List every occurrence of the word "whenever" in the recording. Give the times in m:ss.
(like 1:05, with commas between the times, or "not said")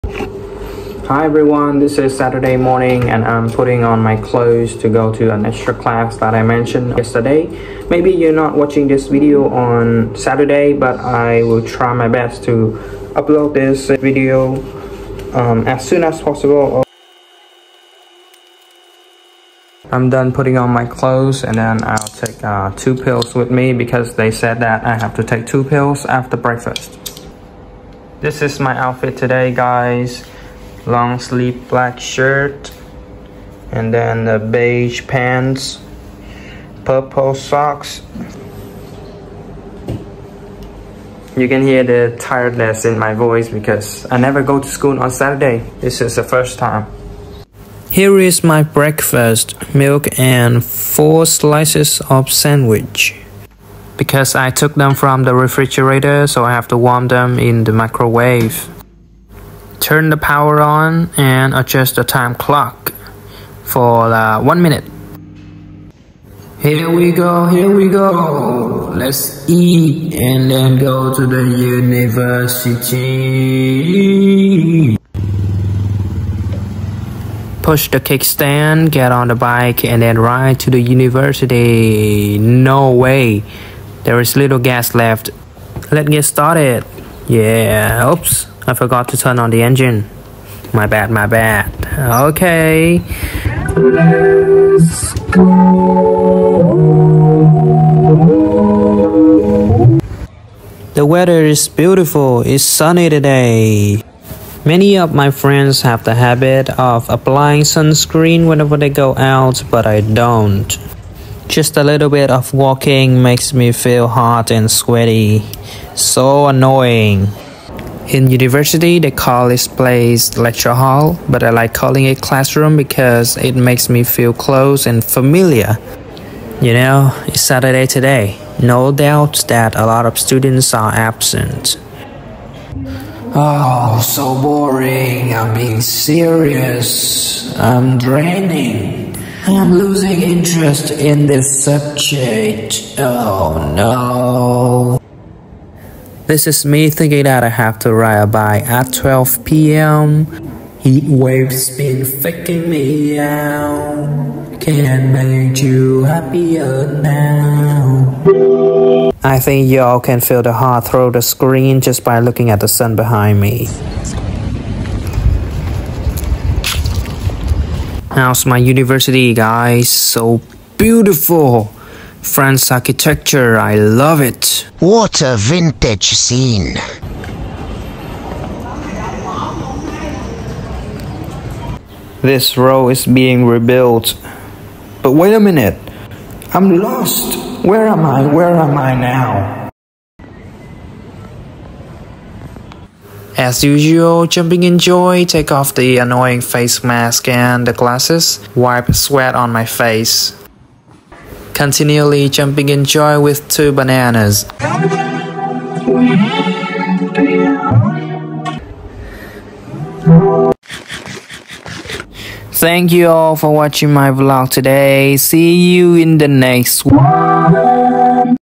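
1:48.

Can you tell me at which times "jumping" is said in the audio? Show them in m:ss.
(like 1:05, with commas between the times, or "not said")
3:14, 3:22.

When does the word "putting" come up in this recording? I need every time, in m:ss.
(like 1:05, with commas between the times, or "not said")
0:03, 0:20.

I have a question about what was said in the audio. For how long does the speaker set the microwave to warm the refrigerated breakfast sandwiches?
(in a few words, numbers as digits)
1 minute.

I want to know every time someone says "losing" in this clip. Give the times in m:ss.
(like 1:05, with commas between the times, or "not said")
2:19.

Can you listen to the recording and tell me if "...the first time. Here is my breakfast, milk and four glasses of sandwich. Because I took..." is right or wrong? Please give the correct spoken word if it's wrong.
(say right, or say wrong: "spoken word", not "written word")
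wrong: "slices", not "glasses".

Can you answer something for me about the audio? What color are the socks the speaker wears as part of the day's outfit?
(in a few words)
Purple.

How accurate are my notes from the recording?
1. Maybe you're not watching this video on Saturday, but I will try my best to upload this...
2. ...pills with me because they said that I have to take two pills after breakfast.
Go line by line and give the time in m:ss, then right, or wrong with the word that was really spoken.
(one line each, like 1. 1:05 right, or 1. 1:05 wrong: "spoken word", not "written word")
1. 0:07 right
2. 0:22 right.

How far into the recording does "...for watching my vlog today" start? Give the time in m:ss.
3:33.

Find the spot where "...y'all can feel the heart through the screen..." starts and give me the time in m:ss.
2:39.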